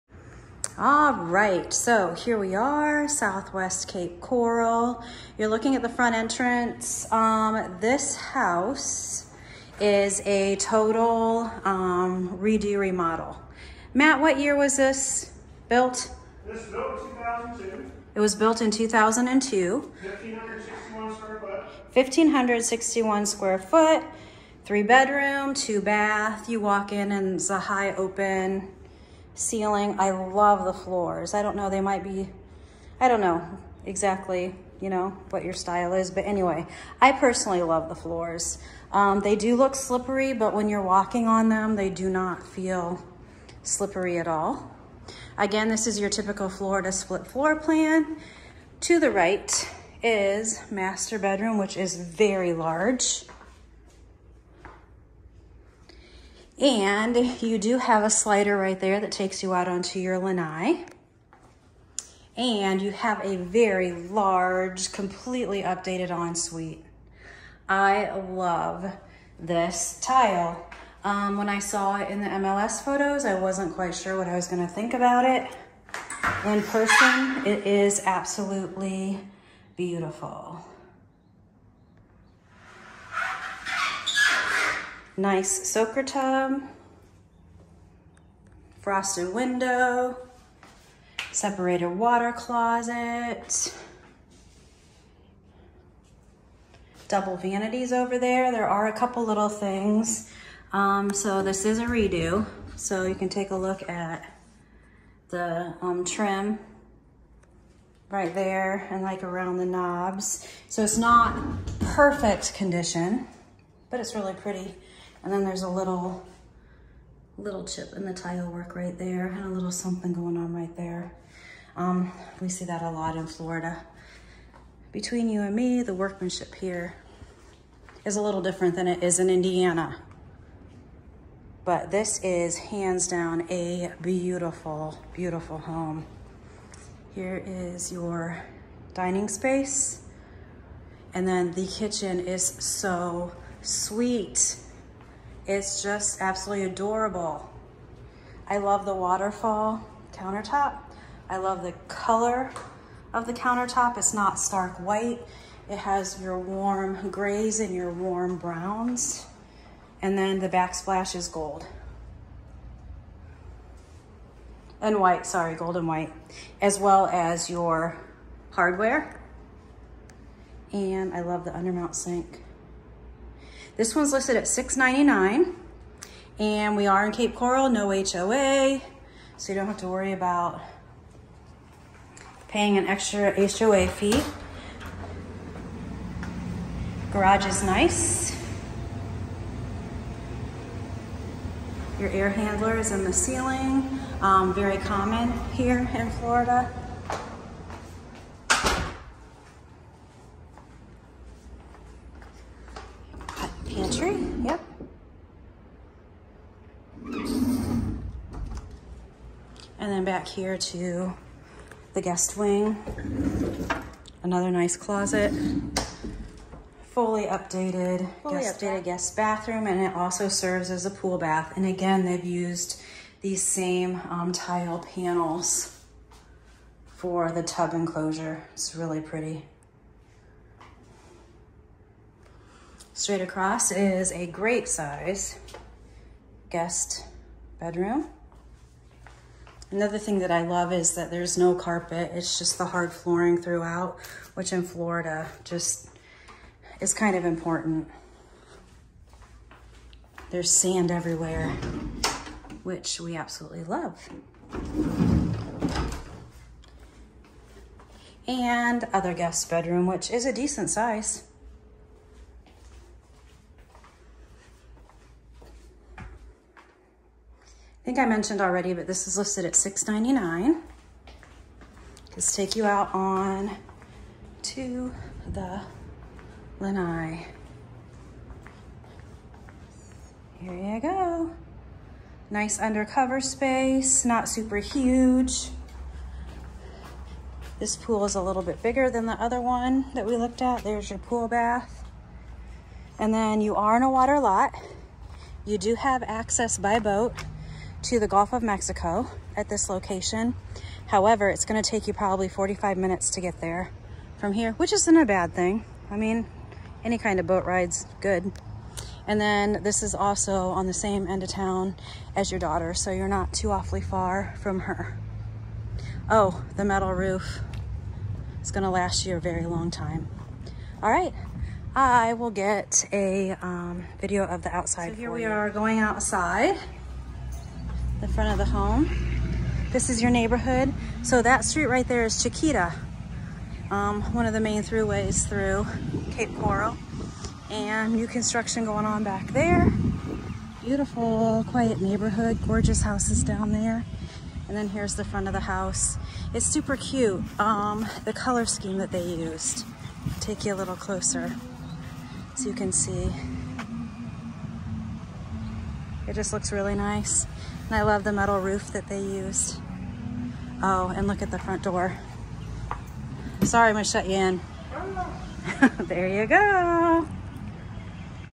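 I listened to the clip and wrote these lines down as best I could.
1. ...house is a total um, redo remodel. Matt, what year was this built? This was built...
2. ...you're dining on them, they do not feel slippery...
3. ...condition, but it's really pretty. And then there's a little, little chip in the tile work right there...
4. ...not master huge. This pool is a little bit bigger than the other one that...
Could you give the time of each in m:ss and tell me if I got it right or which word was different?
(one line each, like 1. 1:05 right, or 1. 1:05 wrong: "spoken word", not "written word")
1. 0:08 right
2. 0:40 wrong: "walking", not "dining"
3. 1:52 right
4. 4:44 wrong: "super", not "master".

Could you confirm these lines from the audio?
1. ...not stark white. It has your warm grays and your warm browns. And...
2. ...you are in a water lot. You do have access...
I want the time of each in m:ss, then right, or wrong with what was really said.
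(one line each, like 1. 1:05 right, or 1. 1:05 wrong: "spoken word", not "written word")
1. 2:34 right
2. 4:53 right.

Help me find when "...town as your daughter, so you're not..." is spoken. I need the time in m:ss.
5:11.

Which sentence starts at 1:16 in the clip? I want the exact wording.
In person, it is absolutely beautiful.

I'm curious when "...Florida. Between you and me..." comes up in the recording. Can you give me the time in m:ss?
2:03.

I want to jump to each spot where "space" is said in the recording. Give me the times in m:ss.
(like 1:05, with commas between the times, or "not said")
2:19, 4:43.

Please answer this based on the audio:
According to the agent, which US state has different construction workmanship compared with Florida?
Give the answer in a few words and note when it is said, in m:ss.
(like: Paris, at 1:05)
Indiana, at 2:09.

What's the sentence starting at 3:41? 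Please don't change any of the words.
And again, they've used these same um, tile panels for the tub enclosure.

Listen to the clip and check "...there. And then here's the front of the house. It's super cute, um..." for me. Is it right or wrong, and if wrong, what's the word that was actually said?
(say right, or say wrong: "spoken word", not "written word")
right.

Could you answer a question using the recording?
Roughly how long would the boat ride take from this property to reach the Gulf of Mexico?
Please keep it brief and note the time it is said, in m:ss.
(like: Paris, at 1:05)
45 minutes, at 5:02.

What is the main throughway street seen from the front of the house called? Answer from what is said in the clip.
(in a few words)
Chiquita.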